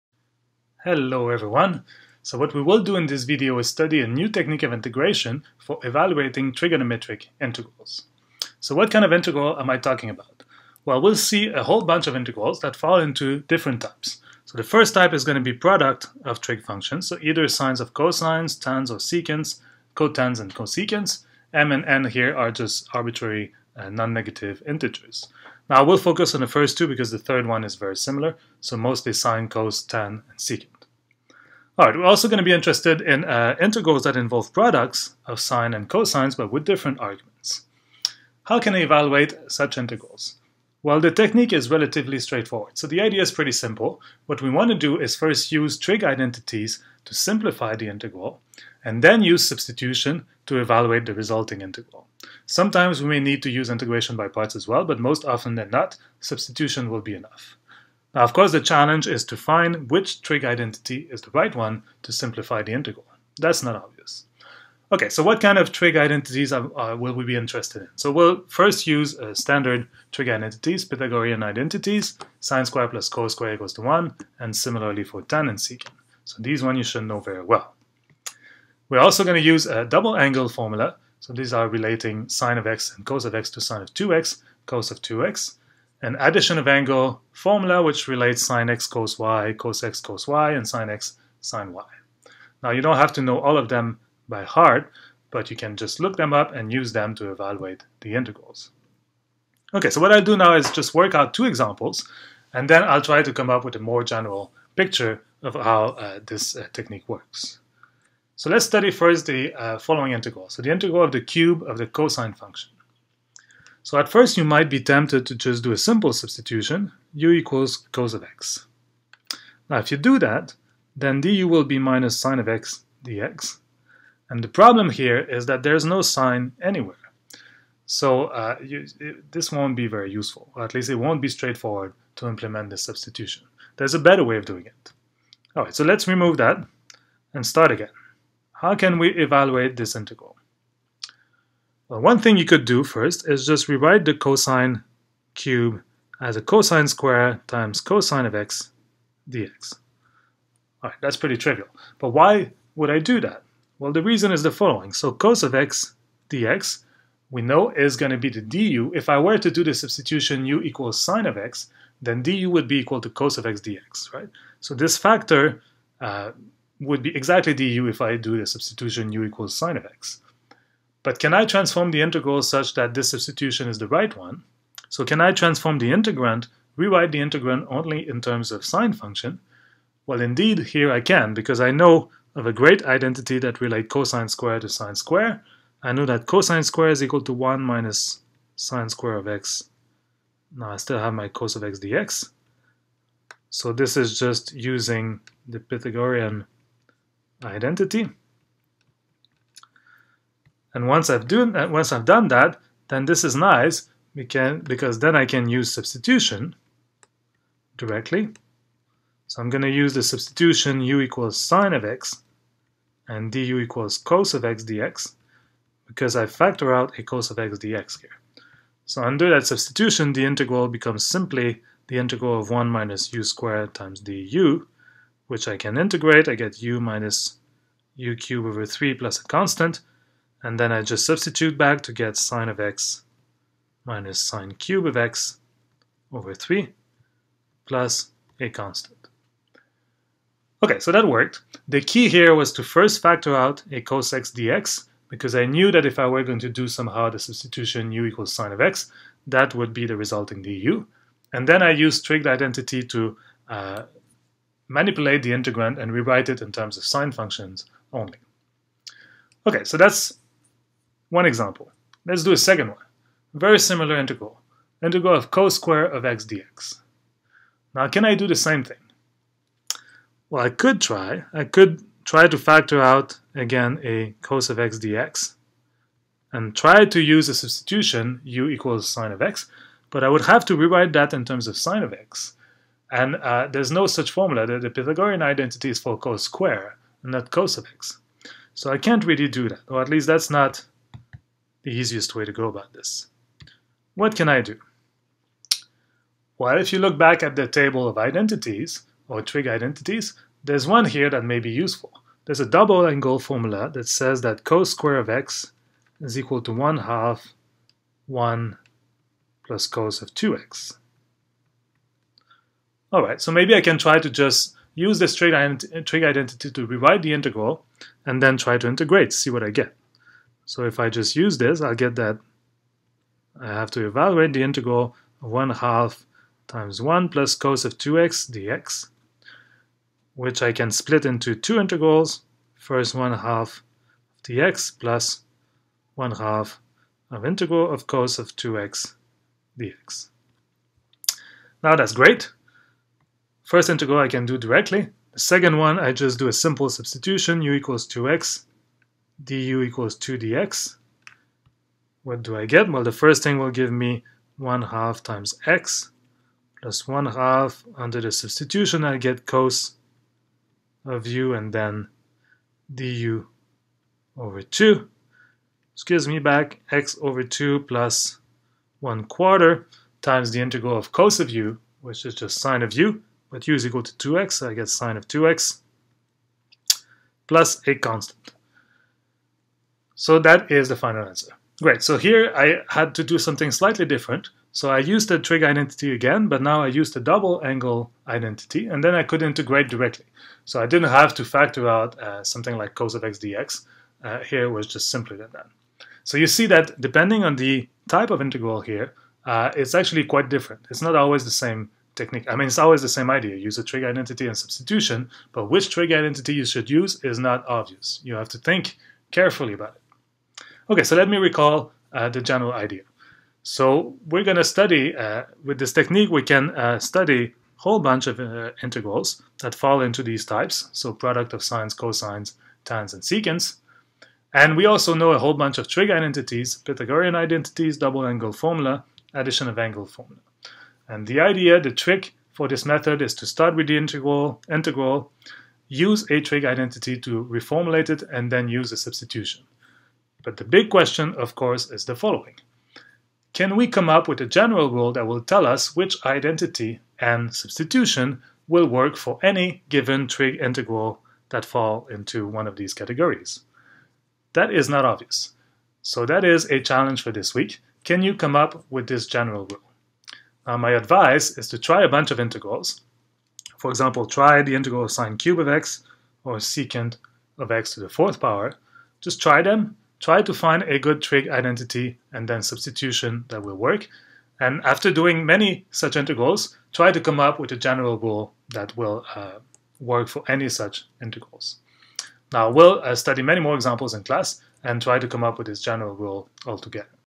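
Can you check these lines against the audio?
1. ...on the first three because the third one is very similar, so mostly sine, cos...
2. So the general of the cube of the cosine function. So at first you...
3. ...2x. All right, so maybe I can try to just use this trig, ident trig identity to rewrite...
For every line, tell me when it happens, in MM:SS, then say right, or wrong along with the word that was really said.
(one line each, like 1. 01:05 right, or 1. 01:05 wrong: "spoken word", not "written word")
1. 00:26 wrong: "two", not "three"
2. 01:50 wrong: "integral", not "general"
3. 05:10 right.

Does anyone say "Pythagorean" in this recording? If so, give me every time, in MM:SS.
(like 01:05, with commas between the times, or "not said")
01:10, 03:15, 04:44, 07:06.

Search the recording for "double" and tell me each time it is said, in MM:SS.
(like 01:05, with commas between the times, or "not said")
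01:19, 05:02, 06:26, 07:07.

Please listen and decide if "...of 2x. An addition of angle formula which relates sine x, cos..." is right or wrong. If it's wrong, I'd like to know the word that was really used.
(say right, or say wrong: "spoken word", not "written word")
right.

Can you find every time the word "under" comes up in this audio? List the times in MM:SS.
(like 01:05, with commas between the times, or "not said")
03:39, 05:57.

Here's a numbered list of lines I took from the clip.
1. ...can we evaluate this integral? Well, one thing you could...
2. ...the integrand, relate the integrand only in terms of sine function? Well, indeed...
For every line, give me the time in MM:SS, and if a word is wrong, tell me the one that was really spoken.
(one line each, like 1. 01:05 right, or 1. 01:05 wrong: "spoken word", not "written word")
1. 02:18 right
2. 02:55 wrong: "rewrite", not "relate".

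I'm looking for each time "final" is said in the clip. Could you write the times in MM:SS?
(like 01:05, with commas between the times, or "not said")
06:20.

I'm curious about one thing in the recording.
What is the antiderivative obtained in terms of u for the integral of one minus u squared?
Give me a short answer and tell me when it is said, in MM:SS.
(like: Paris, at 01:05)
u minus u cubed over 3, at 03:46.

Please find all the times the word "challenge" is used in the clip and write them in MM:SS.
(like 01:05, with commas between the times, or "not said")
00:58, 07:36.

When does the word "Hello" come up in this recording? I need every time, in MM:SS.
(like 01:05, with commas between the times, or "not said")
00:00.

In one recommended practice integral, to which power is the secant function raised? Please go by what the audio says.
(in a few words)
fourth.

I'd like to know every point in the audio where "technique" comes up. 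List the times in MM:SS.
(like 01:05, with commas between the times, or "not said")
00:04, 00:41, 01:46, 06:41, 06:55.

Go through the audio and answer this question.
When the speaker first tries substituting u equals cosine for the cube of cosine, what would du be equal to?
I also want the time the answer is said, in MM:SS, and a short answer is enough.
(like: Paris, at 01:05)
minus sine of x dx, at 02:01.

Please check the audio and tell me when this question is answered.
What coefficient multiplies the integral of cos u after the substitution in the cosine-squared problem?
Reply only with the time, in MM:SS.
06:08.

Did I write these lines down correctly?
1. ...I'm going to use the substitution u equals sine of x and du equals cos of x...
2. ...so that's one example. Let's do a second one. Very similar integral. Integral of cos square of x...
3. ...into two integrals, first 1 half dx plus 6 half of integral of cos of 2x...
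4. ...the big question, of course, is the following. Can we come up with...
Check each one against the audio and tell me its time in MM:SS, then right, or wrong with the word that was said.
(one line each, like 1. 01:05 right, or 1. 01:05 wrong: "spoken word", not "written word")
1. 03:29 right
2. 04:19 right
3. 05:31 wrong: "1", not "6"
4. 07:20 right.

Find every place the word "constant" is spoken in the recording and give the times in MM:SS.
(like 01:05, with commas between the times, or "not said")
03:49, 03:58, 06:17.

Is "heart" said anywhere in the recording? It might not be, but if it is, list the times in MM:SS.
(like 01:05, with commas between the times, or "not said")
01:34.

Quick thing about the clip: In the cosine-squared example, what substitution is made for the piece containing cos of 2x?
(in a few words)
u equals 2x.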